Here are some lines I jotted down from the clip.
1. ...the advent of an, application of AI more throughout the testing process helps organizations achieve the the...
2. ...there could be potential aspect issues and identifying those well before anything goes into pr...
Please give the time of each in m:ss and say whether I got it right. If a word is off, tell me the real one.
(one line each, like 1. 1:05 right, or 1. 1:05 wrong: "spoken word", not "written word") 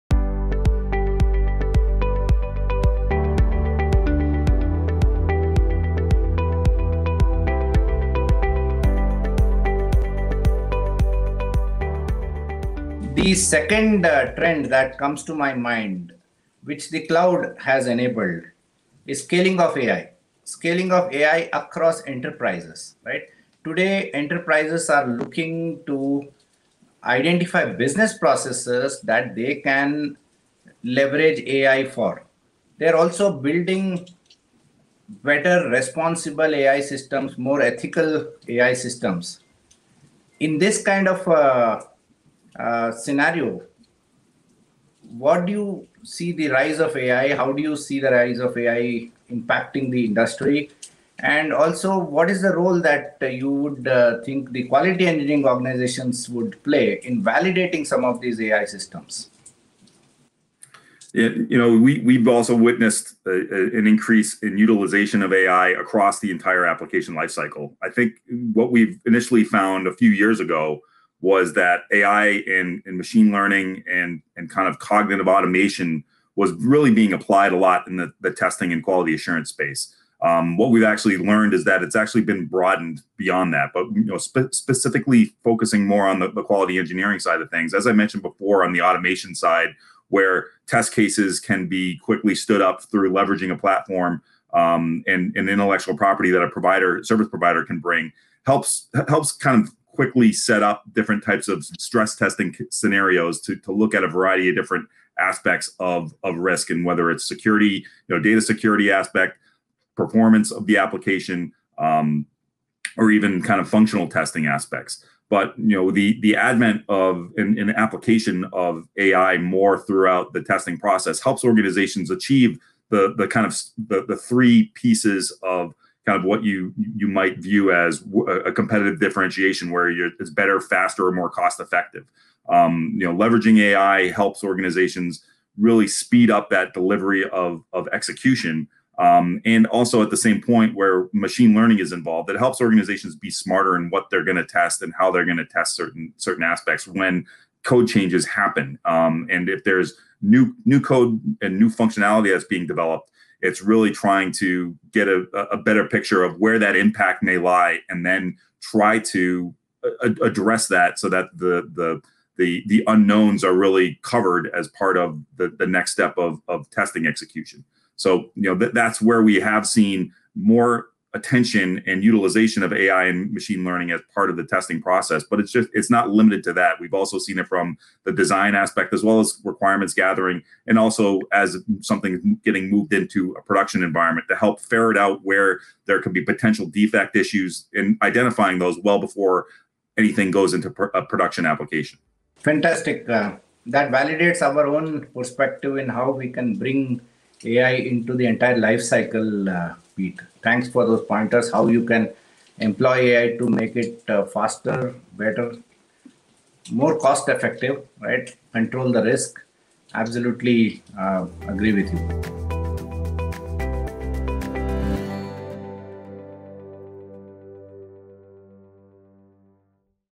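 1. 1:56 right
2. 3:05 wrong: "defect", not "aspect".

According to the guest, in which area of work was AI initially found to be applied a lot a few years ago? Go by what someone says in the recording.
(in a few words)
Testing and quality assurance.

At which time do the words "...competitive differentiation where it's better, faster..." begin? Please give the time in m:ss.
2:08.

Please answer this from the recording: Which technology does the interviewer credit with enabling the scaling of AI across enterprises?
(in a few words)
The cloud.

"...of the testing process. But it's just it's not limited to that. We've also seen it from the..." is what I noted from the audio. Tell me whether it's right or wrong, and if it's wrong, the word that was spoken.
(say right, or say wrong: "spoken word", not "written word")
right.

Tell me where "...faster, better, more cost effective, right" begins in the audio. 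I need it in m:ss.
3:24.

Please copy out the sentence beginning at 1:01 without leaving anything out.
It, you know, we, we've also witnessed a, a, an increase in utilization of AI across the entire application lifecycle.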